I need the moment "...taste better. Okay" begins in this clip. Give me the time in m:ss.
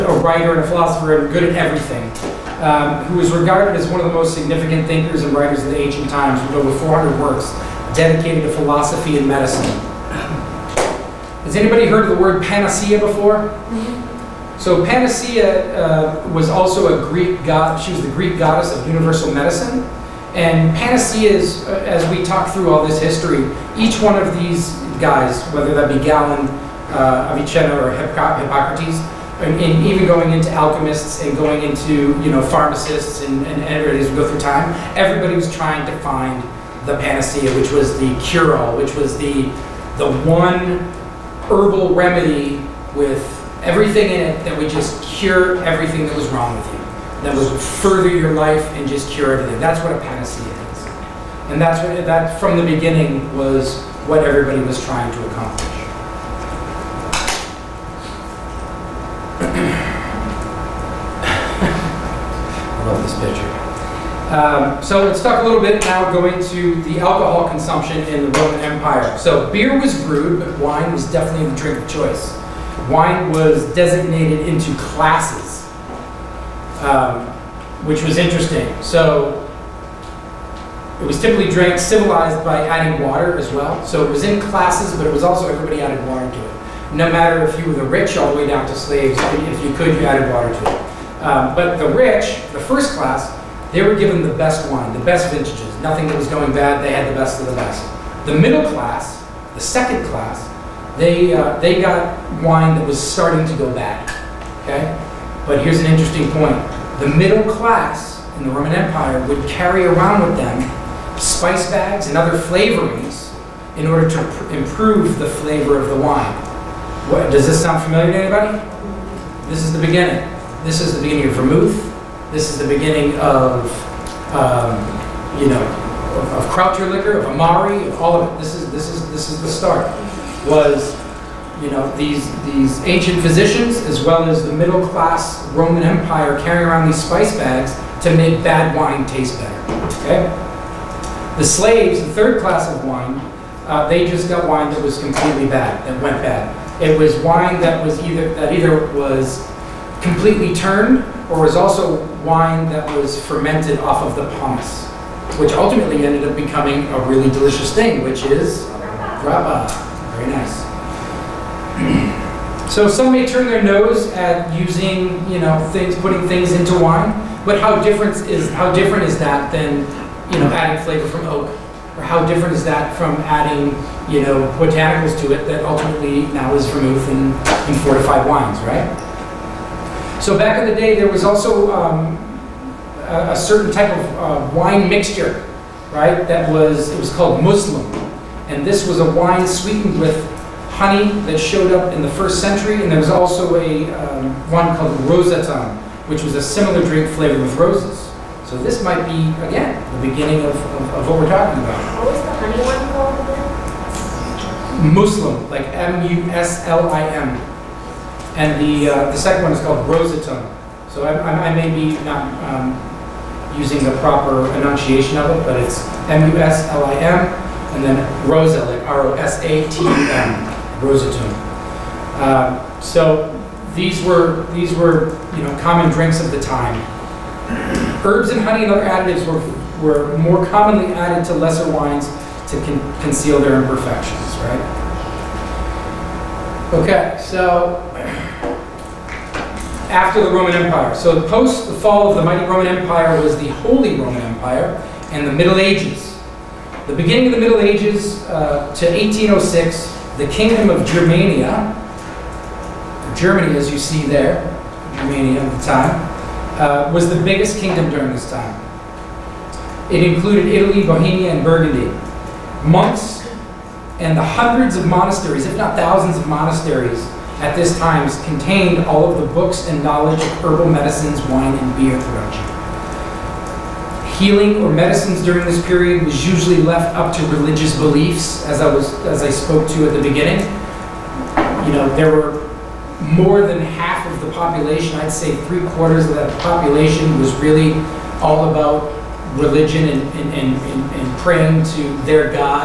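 2:19.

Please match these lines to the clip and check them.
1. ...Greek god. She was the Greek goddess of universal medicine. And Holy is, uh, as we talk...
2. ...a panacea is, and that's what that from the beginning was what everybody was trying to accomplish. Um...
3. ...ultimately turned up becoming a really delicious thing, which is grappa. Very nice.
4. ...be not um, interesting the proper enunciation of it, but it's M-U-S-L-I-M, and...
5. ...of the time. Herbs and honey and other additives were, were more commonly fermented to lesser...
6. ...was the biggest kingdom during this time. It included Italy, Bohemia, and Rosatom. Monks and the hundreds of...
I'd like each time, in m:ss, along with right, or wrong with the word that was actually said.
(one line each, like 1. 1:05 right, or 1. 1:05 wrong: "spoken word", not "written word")
1. 0:17 wrong: "Panacea", not "Holy"
2. 0:49 right
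3. 2:35 wrong: "ended", not "turned"
4. 3:31 wrong: "using", not "interesting"
5. 3:46 wrong: "added", not "fermented"
6. 4:16 wrong: "Burgundy", not "Rosatom".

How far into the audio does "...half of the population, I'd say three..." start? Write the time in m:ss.
4:43.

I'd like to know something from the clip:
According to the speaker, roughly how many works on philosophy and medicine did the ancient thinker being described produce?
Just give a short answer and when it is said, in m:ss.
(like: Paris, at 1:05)
over 400, at 0:06.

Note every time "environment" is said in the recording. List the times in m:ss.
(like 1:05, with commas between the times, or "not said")
not said.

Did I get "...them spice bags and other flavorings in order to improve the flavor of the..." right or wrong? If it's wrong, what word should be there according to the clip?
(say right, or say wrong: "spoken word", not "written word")
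right.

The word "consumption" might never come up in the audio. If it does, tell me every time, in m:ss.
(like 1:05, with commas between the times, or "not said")
1:07.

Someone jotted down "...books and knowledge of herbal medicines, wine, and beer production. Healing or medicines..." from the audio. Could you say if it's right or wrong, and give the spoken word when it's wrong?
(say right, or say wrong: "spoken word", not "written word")
right.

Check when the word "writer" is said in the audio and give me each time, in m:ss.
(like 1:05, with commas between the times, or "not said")
0:00, 0:05.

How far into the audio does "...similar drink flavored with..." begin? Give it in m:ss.
3:16.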